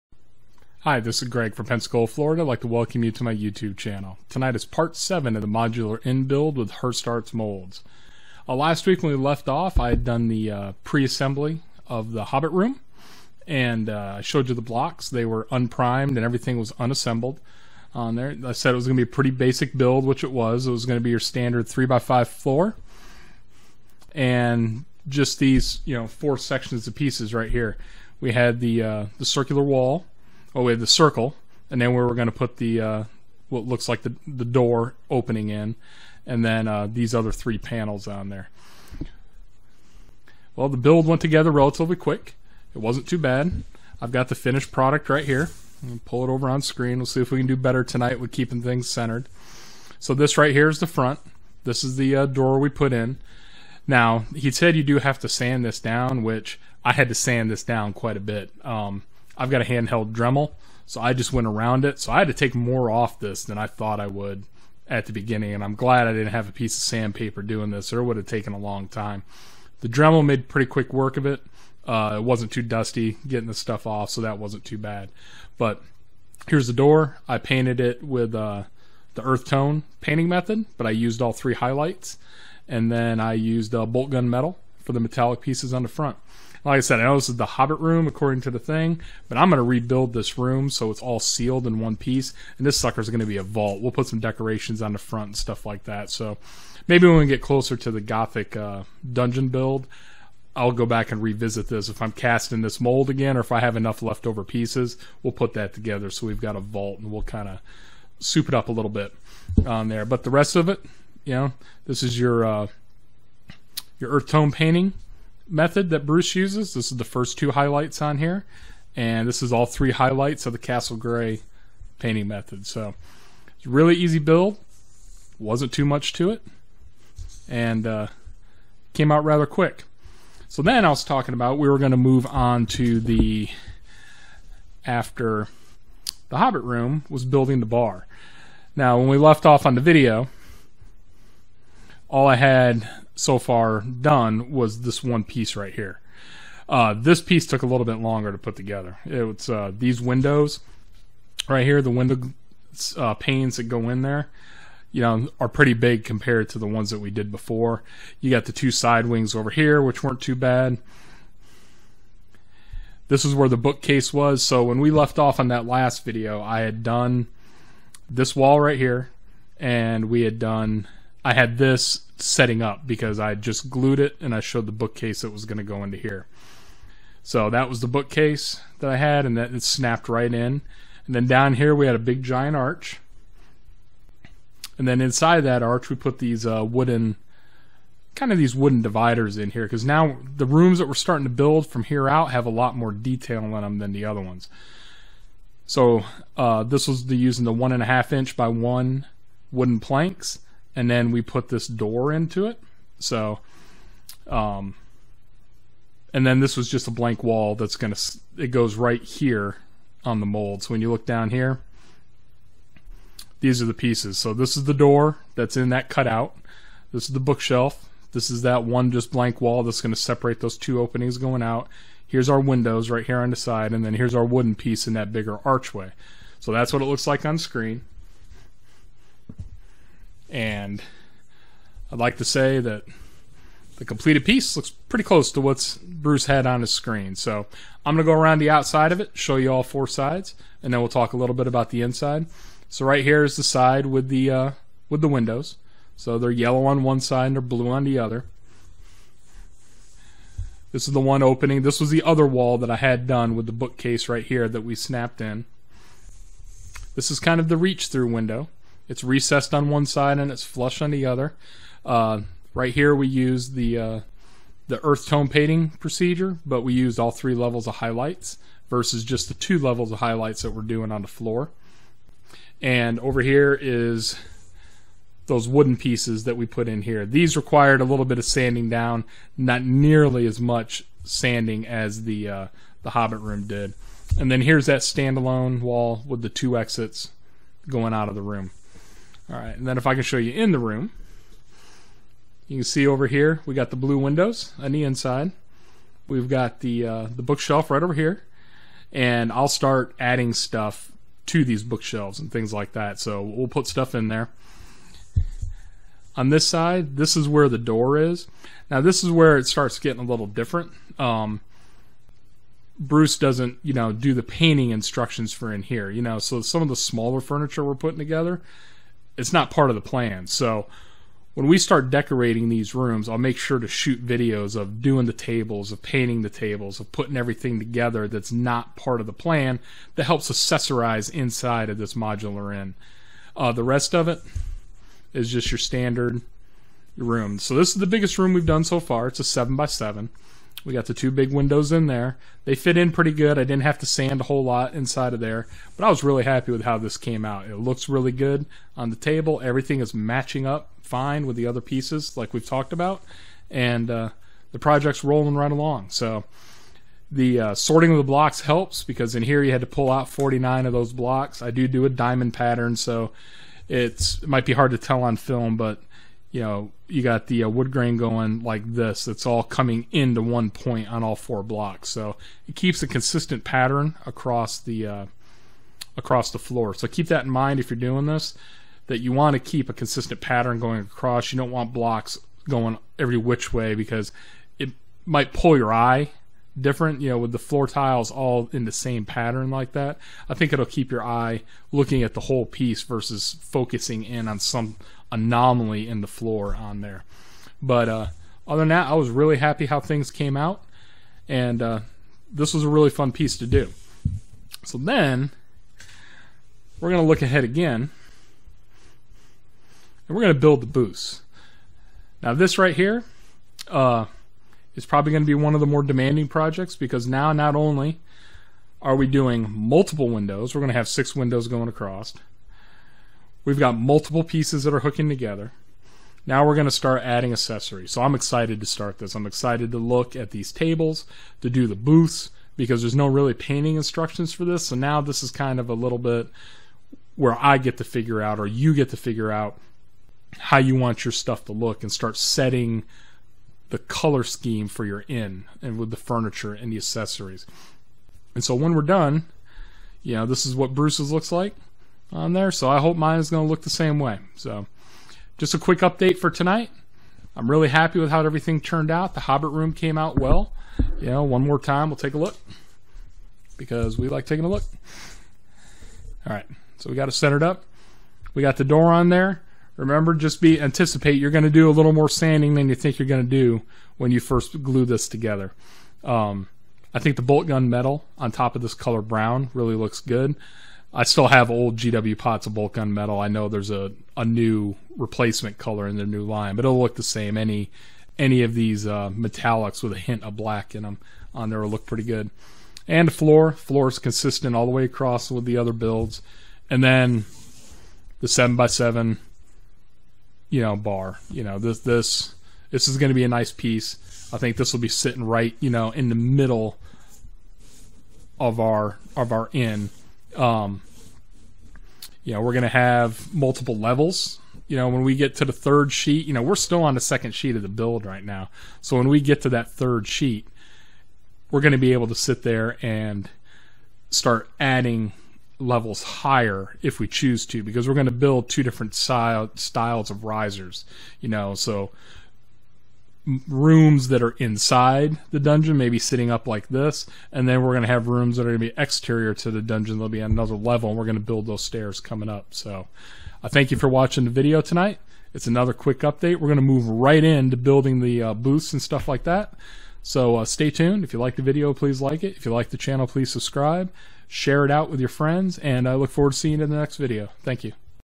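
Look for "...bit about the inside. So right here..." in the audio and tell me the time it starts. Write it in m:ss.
4:01.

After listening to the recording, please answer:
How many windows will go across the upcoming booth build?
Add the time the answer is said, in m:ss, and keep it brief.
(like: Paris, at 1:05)
6, at 7:00.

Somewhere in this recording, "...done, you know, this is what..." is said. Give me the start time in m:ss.
7:28.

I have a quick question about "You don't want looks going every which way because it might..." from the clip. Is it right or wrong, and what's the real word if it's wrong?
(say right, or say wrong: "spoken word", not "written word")
wrong: "blocks", not "looks".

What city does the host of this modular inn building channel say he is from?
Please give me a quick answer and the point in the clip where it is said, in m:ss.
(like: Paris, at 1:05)
Pensacola, Florida, at 0:01.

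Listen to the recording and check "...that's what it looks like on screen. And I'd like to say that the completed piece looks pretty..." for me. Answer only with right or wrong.
right.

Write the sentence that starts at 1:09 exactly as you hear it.
The Dremel made pretty quick work of it.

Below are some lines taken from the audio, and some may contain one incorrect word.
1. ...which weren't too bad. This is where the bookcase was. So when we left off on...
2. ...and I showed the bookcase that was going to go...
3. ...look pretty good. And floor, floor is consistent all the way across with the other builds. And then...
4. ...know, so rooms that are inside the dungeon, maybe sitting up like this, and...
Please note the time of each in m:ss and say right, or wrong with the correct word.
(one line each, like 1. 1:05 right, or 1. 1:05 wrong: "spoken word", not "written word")
1. 2:39 right
2. 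2:54 right
3. 8:11 right
4. 8:51 right.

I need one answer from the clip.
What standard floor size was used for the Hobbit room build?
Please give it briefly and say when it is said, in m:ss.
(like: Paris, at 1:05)
3x5, at 0:21.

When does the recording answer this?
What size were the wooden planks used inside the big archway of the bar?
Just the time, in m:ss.
3:17.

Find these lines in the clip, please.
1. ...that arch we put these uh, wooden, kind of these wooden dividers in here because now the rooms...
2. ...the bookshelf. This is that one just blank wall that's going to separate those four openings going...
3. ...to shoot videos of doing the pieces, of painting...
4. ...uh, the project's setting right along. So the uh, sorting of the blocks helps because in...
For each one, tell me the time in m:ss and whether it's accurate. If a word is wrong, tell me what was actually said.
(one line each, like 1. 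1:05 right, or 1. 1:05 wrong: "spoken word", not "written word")
1. 3:05 right
2. 3:37 wrong: "two", not "four"
3. 5:23 wrong: "tables", not "pieces"
4. 5:53 wrong: "rolling", not "setting".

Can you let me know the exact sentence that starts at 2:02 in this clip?
So, really easy build, wasn't too much to it, and uh, came out rather quick.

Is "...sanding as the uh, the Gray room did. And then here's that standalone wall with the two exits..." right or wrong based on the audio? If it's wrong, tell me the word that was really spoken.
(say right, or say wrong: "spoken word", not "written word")
wrong: "Hobbit", not "Gray".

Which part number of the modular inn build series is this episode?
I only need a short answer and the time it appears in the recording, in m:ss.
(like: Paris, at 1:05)
7, at 0:04.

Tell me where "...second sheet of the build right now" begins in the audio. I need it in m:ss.
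8:37.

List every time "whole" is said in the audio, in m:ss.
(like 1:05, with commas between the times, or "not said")
5:44, 6:32.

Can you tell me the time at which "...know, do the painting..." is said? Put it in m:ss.
5:13.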